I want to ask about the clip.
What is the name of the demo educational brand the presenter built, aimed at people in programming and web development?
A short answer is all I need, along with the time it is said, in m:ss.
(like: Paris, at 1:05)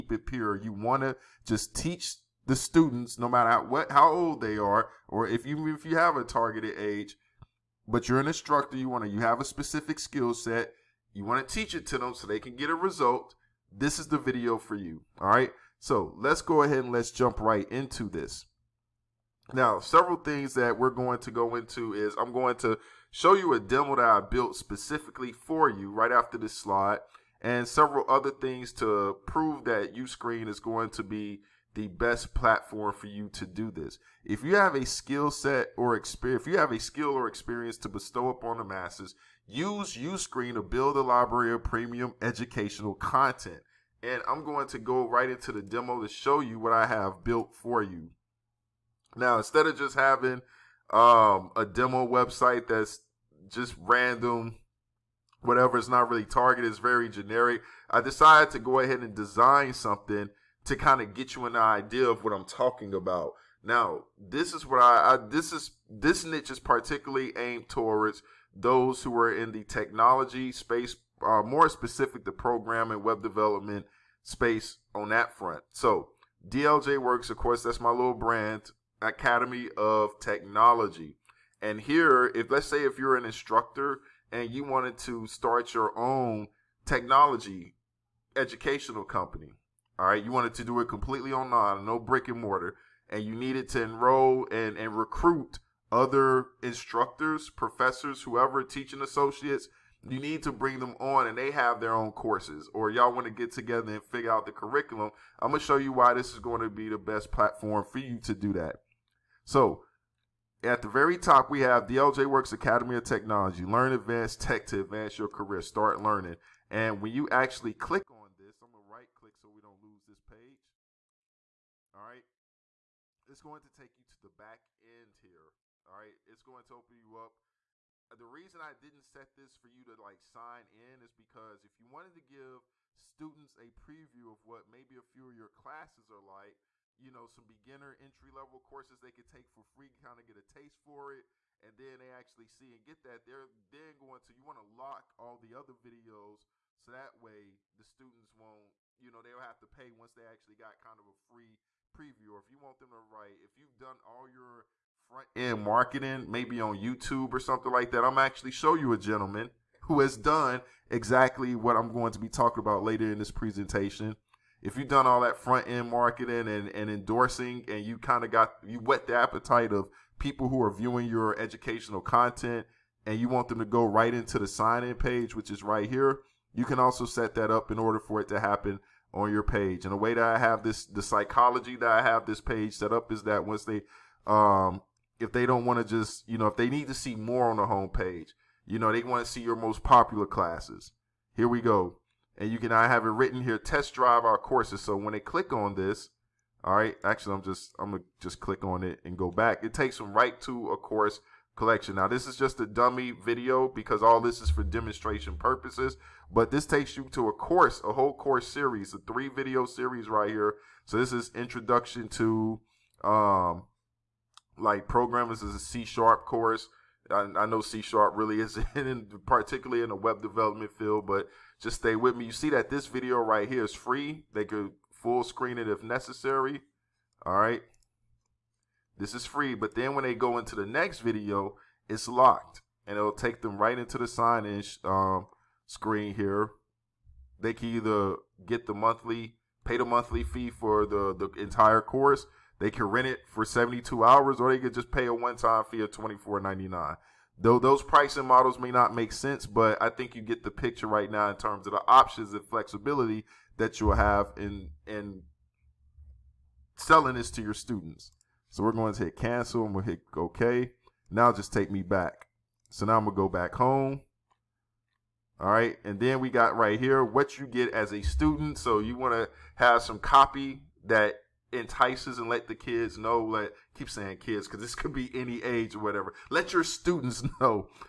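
DLJ Works Academy of Technology, at 1:16.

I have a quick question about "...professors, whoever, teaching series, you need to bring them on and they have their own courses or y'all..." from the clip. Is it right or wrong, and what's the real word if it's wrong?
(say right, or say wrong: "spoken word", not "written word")
wrong: "associates", not "series".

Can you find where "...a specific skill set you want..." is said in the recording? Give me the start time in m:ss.
0:09.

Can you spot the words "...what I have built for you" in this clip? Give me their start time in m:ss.
0:46.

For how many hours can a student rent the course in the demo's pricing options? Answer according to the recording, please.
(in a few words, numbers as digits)
72.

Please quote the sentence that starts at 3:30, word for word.
So this is introduction to um like programmers is a C sharp course.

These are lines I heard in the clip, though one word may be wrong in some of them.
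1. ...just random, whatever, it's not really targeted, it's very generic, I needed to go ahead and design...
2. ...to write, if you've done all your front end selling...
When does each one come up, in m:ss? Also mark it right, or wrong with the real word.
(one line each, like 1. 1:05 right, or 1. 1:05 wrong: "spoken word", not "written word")
1. 0:53 wrong: "decided", not "needed"
2. 2:32 wrong: "marketing", not "selling".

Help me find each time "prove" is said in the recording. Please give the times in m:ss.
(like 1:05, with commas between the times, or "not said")
0:29.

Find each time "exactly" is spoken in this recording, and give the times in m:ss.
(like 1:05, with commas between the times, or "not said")
2:40.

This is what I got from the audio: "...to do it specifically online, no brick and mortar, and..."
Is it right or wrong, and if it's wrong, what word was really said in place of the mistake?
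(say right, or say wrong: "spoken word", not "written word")
wrong: "completely", not "specifically".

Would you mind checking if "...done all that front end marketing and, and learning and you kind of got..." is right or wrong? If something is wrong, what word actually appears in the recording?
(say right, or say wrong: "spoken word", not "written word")
wrong: "endorsing", not "learning".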